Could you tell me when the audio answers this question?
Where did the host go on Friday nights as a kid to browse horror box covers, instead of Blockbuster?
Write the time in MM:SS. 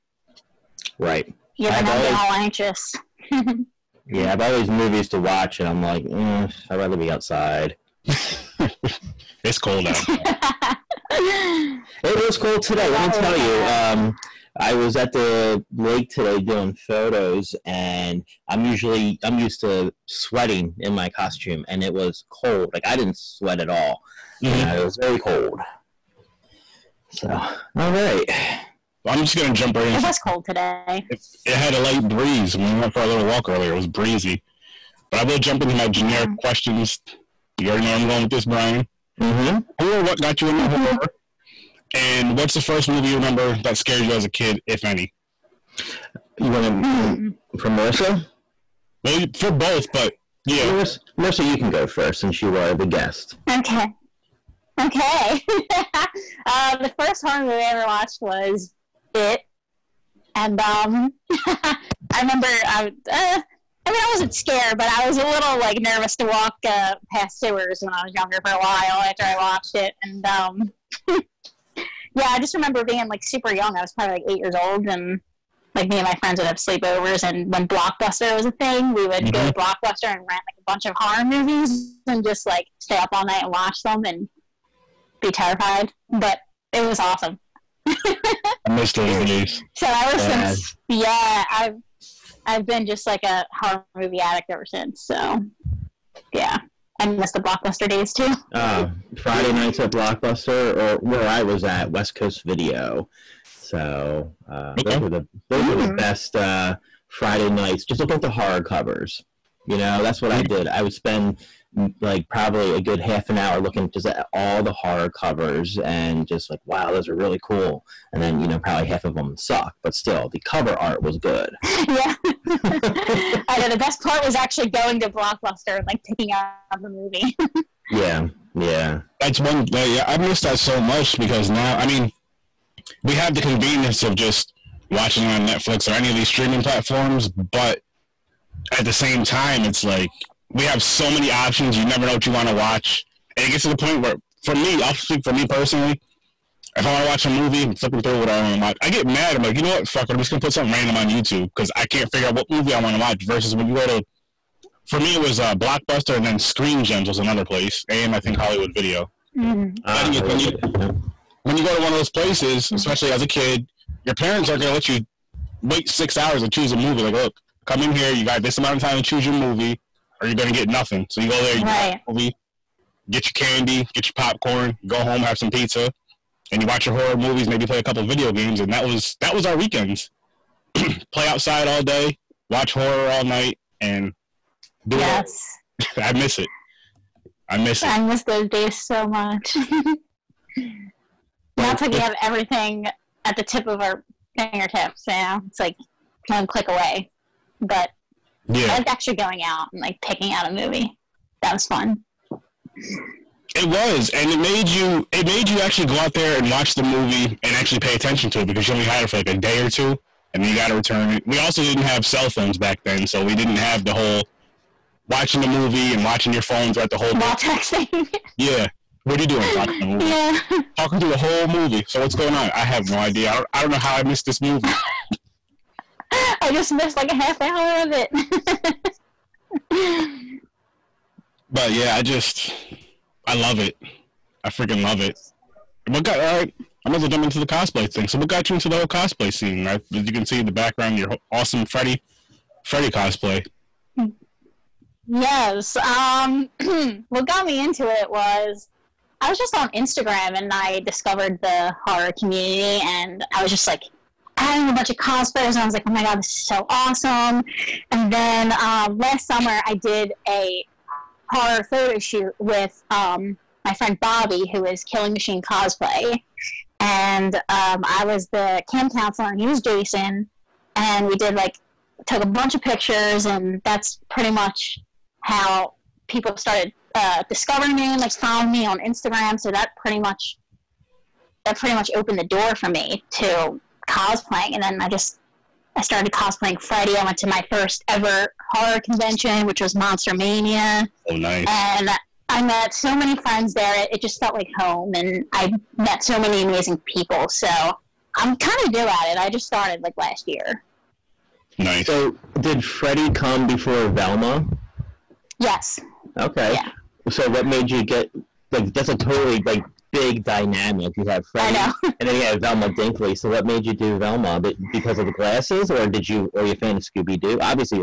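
01:41.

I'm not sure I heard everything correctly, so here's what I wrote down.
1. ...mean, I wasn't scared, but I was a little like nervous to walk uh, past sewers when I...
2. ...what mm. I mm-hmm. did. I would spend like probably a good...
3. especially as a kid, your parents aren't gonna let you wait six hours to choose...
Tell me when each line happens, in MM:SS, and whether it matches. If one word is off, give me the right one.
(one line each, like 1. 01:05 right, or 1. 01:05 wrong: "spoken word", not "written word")
1. 01:03 right
2. 01:50 right
3. 02:42 right.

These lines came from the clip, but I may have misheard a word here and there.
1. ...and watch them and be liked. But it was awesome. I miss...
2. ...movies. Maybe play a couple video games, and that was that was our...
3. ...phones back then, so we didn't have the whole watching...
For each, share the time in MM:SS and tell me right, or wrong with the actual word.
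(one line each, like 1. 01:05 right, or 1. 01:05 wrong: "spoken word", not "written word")
1. 01:23 wrong: "terrified", not "liked"
2. 02:57 right
3. 03:32 right.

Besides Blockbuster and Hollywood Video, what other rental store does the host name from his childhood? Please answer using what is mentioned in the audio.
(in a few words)
Screen Gems.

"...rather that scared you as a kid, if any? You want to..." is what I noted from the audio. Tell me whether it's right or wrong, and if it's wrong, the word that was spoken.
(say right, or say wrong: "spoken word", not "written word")
wrong: "remember", not "rather".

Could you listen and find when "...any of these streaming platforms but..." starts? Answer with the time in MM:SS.
02:15.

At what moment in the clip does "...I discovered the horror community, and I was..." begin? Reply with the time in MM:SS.
04:10.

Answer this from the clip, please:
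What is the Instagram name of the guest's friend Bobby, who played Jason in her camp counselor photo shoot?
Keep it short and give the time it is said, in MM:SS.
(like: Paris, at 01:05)
Killing Machine Cosplay, at 04:24.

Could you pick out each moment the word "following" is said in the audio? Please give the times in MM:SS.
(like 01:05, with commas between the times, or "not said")
04:38.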